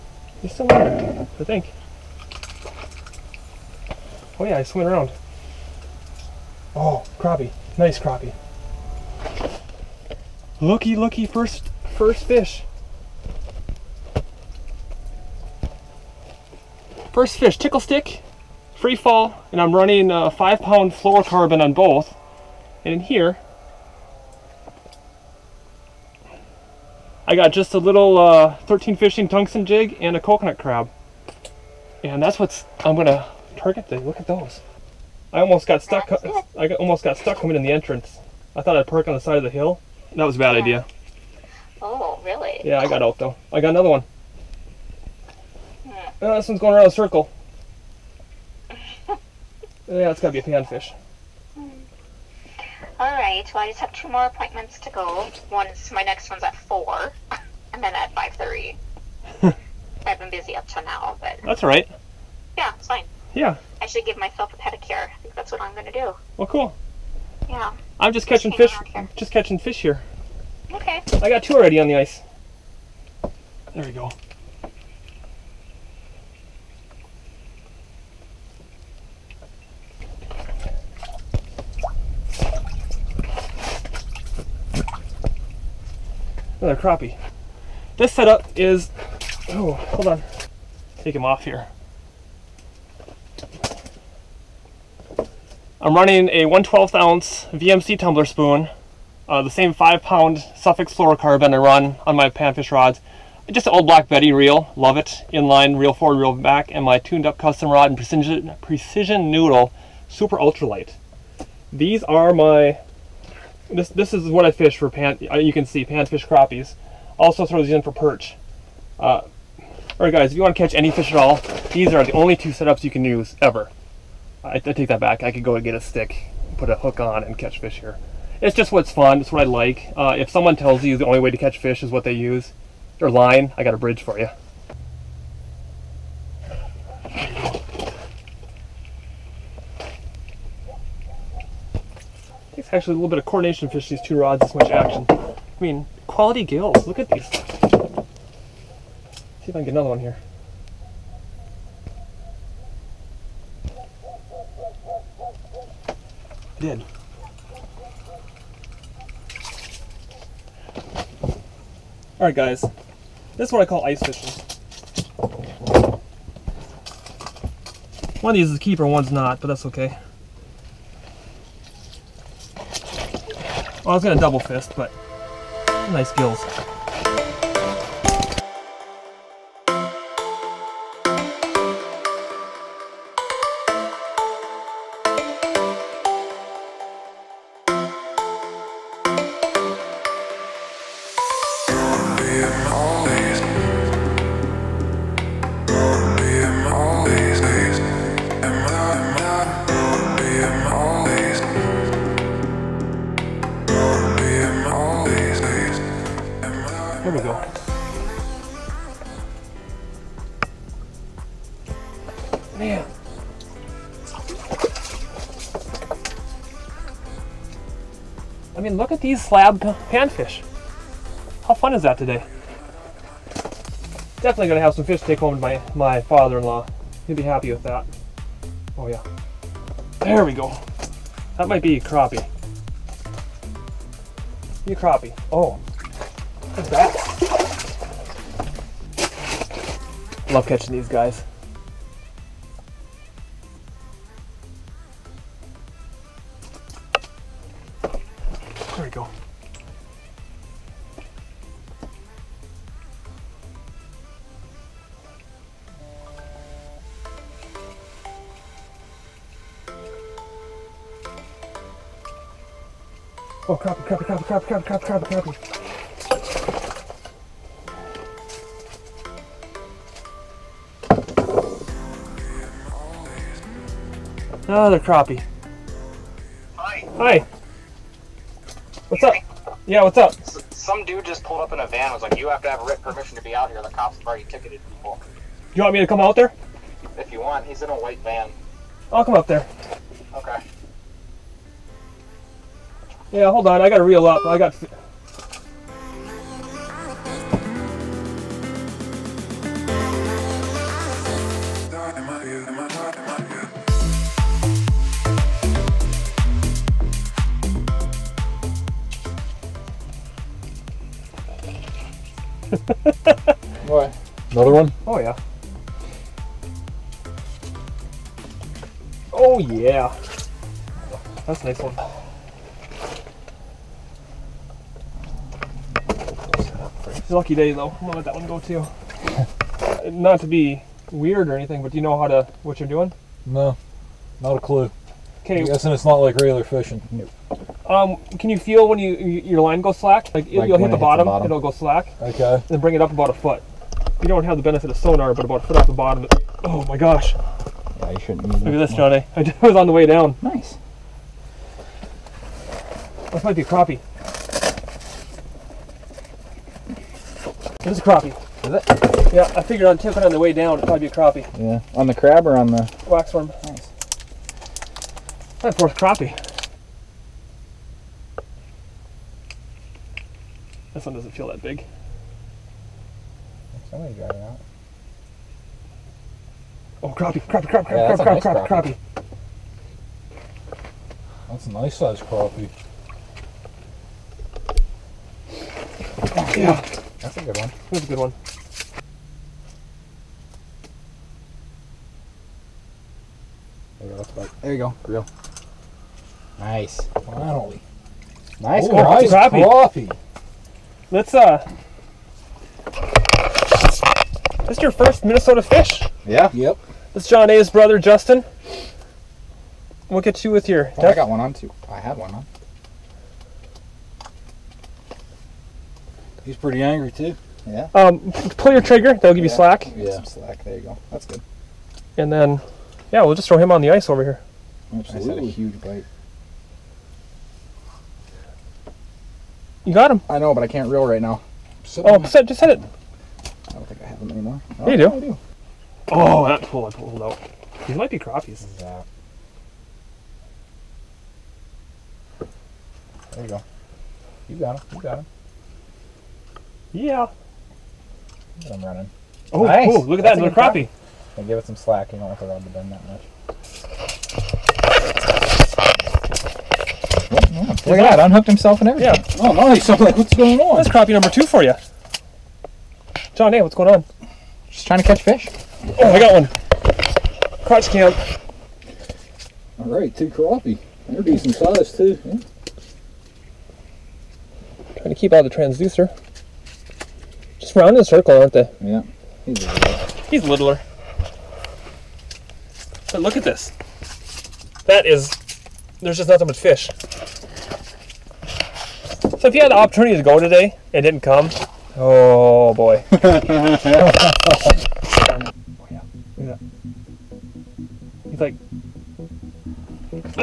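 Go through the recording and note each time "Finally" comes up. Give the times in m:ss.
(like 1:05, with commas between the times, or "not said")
6:37.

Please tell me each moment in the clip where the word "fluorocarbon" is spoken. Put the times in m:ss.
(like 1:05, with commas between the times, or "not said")
0:20, 1:40.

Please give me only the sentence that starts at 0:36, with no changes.
I got, almost got stuck coming in the entrance.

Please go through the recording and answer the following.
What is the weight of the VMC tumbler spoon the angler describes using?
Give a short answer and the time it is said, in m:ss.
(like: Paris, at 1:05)
1/12 ounce, at 1:36.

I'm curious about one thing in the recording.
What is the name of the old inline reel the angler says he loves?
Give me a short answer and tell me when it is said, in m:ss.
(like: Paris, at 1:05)
Black Betty, at 1:43.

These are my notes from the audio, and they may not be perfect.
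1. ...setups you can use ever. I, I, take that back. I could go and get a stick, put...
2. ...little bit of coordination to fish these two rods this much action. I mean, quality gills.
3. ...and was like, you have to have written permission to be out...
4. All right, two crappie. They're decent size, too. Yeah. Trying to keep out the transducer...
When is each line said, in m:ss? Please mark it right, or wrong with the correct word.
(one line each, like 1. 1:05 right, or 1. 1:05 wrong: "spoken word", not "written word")
1. 2:02 right
2. 2:22 right
3. 4:41 right
4. 7:49 right.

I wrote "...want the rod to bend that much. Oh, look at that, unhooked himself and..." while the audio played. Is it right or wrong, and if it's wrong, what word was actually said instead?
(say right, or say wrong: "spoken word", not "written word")
right.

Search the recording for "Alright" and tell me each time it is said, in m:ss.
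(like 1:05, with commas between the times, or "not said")
1:59, 2:42.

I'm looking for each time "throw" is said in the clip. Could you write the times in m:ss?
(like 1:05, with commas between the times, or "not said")
1:57, 7:03.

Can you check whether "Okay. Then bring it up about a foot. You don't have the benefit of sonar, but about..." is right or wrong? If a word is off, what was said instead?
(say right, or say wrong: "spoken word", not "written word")
right.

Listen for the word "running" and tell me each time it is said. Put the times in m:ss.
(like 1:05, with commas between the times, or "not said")
0:19, 1:35, 7:28.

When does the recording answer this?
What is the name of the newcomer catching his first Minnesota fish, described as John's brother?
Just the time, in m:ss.
6:47.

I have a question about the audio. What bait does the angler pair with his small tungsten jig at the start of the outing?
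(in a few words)
coconut crab.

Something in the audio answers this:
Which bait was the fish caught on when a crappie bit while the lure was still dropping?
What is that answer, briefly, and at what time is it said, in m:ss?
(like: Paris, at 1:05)
waxworm, at 6:02.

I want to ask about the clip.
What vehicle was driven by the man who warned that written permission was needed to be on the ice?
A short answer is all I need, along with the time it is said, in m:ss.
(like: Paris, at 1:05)
white van, at 4:47.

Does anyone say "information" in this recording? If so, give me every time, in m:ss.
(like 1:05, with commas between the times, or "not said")
not said.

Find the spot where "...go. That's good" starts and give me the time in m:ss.
7:00.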